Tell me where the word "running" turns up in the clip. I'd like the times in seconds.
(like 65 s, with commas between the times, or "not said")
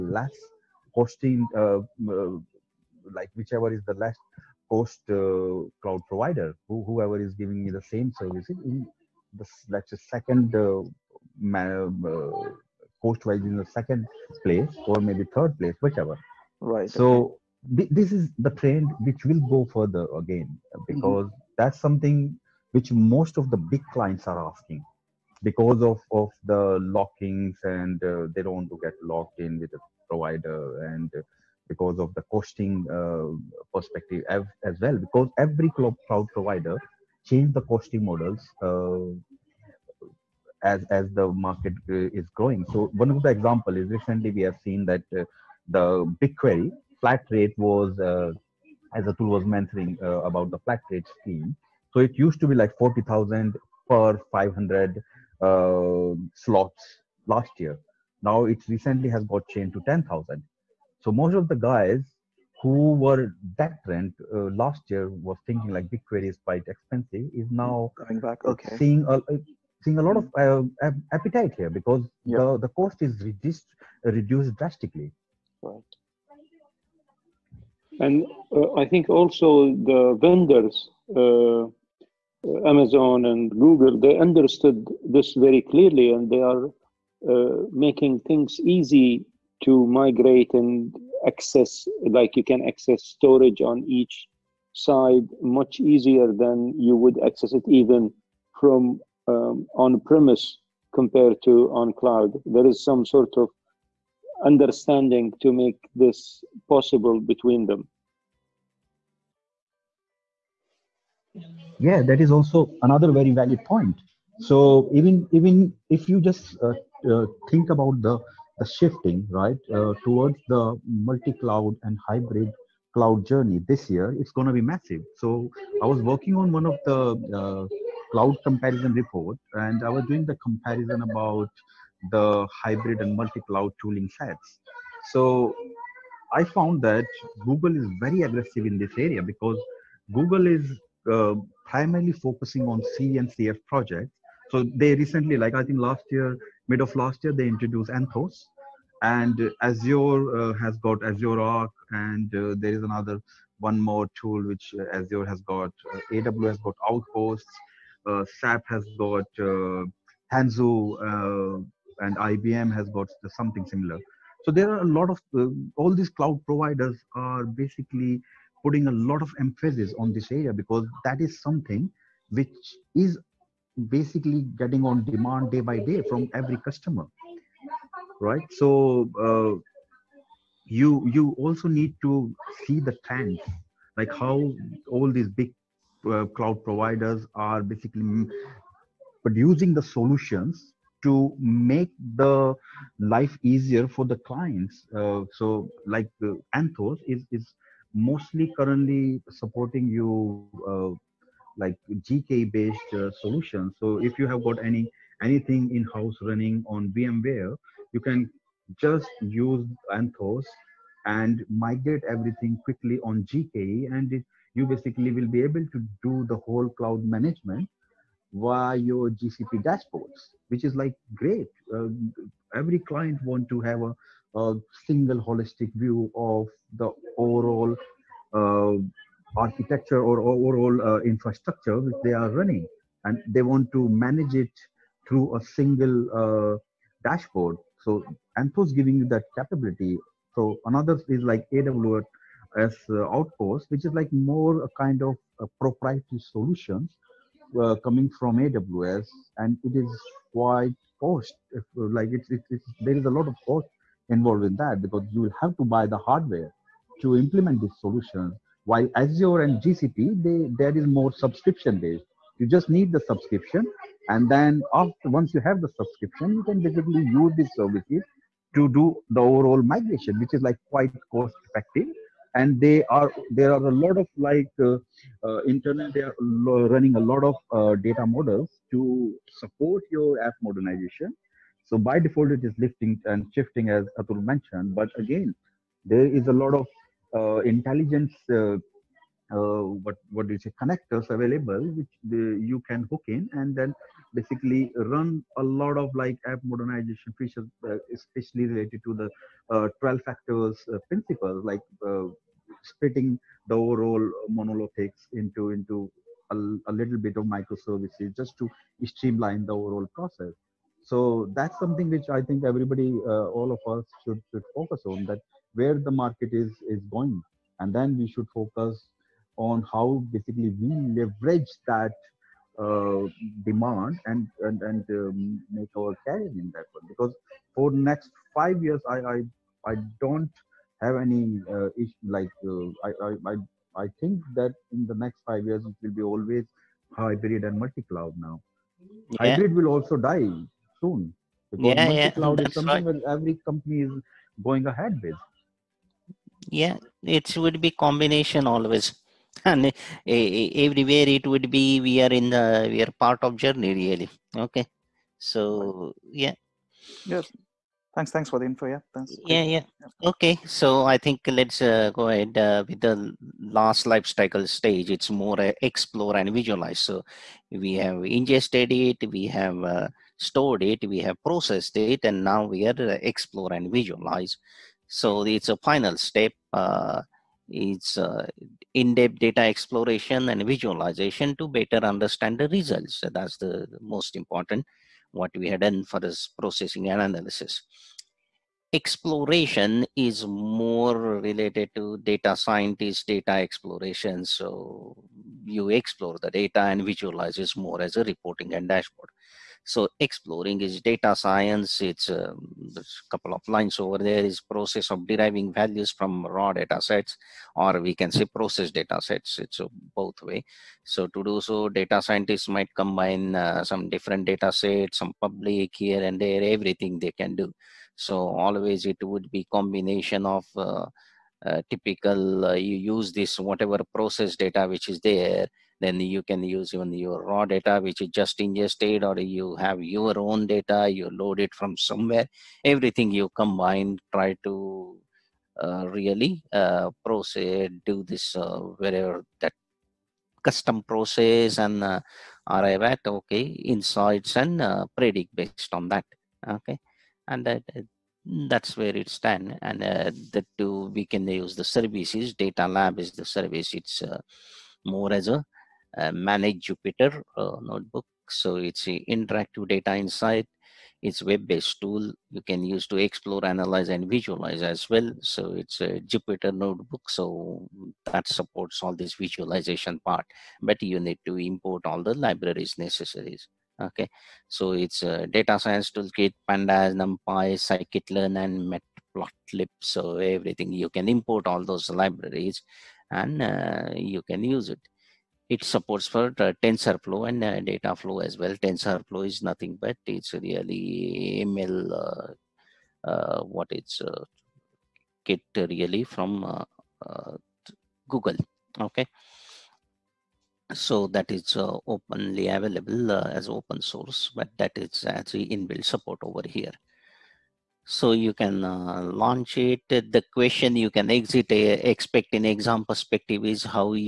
206 s, 232 s, 276 s.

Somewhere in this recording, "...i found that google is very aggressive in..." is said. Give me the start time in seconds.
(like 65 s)
136 s.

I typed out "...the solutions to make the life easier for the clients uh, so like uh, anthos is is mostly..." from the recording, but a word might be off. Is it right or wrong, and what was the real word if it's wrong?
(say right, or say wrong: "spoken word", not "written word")
right.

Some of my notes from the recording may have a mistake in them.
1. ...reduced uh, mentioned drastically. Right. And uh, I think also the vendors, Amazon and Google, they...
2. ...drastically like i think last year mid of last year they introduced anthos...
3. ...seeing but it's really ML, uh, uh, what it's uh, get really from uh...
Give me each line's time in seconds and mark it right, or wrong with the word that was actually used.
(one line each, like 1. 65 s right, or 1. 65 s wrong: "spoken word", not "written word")
1. 73 s wrong: "reduced", not "mentioned"
2. 144 s wrong: "recently", not "drastically"
3. 489 s wrong: "nothing", not "seeing".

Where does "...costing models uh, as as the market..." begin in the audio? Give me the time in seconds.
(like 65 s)
37 s.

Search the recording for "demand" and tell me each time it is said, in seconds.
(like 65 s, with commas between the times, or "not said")
175 s, 323 s.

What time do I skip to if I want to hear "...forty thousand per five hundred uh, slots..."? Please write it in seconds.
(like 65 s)
52 s.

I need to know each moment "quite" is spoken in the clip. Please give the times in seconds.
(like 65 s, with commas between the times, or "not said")
66 s, 250 s, 270 s.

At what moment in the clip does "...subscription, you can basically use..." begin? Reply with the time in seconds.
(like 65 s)
265 s.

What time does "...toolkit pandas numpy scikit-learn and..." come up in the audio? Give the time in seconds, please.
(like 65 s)
475 s.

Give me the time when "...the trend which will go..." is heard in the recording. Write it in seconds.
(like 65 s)
18 s.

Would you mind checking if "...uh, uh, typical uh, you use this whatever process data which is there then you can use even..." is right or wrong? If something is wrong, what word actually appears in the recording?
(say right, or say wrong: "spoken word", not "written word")
right.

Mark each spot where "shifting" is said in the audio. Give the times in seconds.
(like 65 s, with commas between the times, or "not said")
118 s, 283 s.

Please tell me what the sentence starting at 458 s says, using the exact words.
So it's an interactive data insight.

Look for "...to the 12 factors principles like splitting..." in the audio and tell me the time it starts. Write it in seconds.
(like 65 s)
298 s.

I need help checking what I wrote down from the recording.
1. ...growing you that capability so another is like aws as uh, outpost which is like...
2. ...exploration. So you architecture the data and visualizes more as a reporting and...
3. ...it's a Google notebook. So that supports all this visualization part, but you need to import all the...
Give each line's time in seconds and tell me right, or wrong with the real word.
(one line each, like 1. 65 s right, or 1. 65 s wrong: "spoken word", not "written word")
1. 238 s wrong: "giving", not "growing"
2. 393 s wrong: "explore", not "architecture"
3. 465 s wrong: "Jupyter", not "Google".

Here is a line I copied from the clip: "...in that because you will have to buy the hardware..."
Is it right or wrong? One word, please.
right.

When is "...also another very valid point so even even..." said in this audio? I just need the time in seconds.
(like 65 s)
112 s.